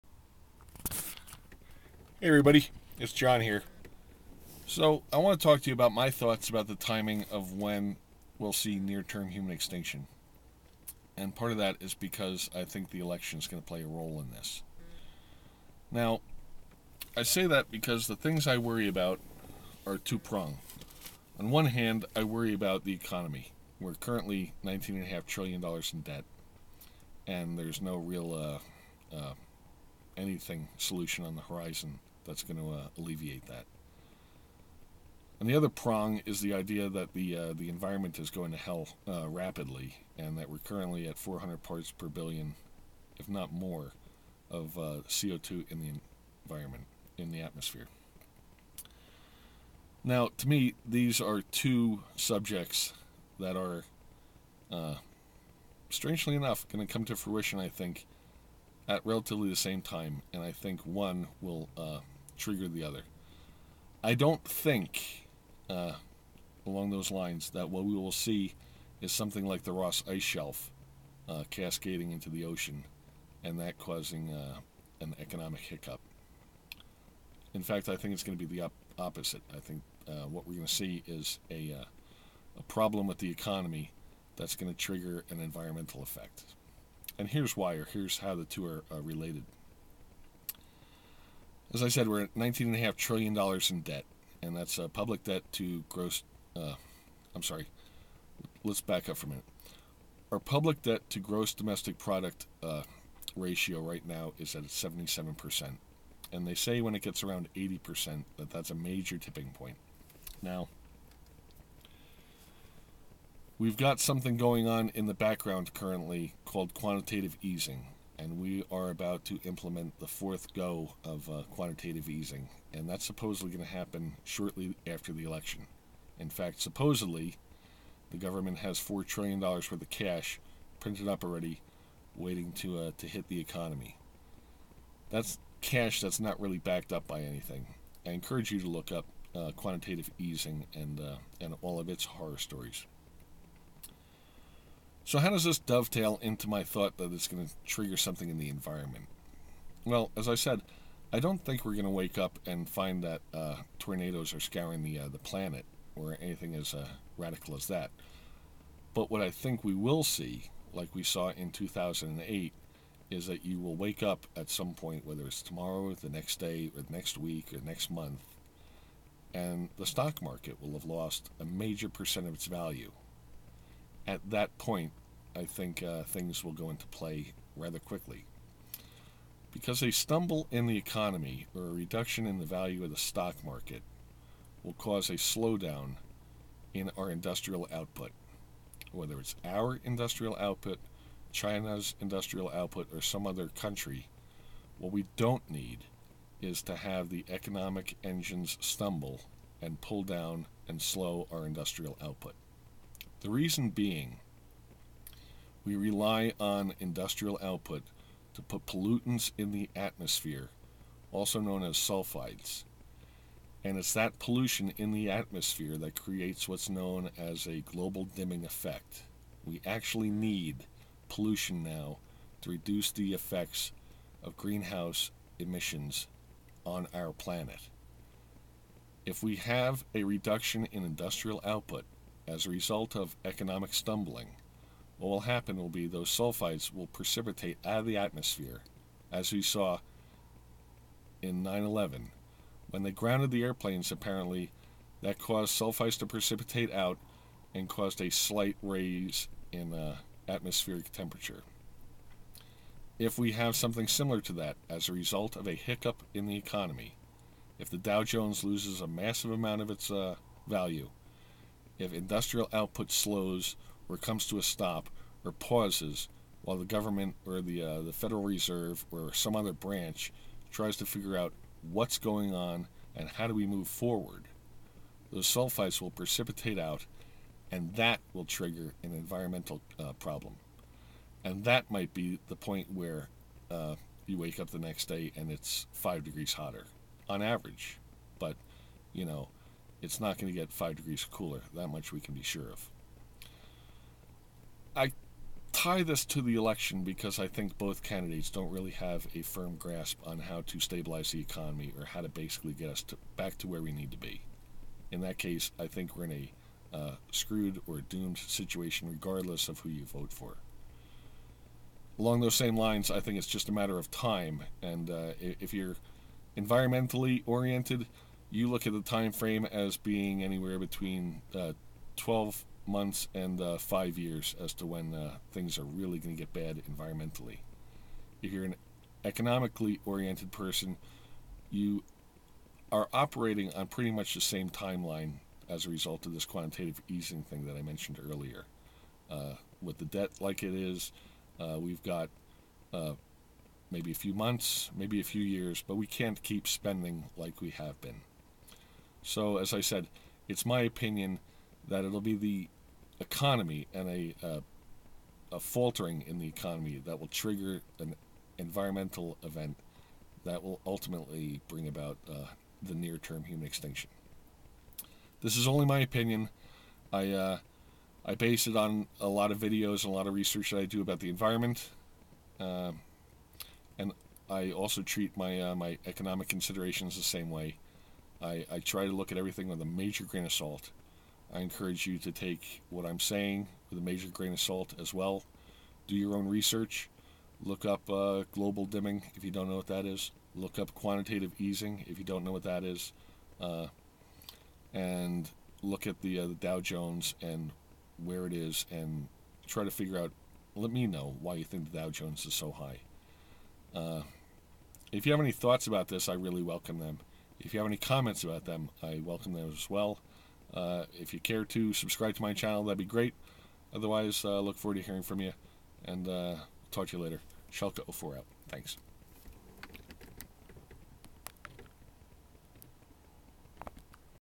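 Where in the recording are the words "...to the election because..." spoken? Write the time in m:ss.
4:56.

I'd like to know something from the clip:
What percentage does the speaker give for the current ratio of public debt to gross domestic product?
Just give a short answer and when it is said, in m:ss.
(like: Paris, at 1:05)
77%, at 1:44.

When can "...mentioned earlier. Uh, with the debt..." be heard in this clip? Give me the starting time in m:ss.
5:37.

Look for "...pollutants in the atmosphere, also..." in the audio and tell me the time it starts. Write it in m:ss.
3:28.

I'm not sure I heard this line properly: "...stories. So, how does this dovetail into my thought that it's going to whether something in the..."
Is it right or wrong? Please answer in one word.
wrong.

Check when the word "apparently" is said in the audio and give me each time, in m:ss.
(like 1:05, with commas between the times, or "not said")
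4:03.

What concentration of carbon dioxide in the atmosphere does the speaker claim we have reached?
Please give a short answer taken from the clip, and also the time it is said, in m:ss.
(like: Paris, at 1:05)
400 parts per billion, at 0:41.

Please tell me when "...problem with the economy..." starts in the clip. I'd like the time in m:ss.
1:22.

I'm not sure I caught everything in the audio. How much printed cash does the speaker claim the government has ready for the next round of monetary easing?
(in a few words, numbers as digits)
4 trillion dollars.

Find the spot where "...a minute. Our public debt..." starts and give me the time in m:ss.
1:39.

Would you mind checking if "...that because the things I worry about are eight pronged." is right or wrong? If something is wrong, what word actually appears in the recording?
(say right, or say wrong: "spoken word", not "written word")
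wrong: "two", not "eight".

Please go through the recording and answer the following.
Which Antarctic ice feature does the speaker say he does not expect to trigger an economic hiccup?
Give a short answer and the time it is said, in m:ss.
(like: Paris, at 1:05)
Ross Ice Shelf, at 1:09.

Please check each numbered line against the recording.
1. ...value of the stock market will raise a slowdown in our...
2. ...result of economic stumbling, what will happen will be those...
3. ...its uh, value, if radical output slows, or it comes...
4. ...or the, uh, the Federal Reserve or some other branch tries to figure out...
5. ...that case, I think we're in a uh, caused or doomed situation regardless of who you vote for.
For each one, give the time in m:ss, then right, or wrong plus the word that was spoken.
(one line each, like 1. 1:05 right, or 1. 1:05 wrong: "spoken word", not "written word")
1. 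3:02 wrong: "cause", not "raise"
2. 3:52 right
3. 4:19 wrong: "industrial", not "radical"
4. 4:27 right
5. 5:05 wrong: "screwed", not "caused".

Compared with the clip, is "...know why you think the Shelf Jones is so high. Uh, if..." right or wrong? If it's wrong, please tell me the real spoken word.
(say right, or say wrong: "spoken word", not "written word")
wrong: "Dow", not "Shelf".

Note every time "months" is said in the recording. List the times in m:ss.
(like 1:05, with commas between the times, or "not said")
2:47, 5:22, 5:44.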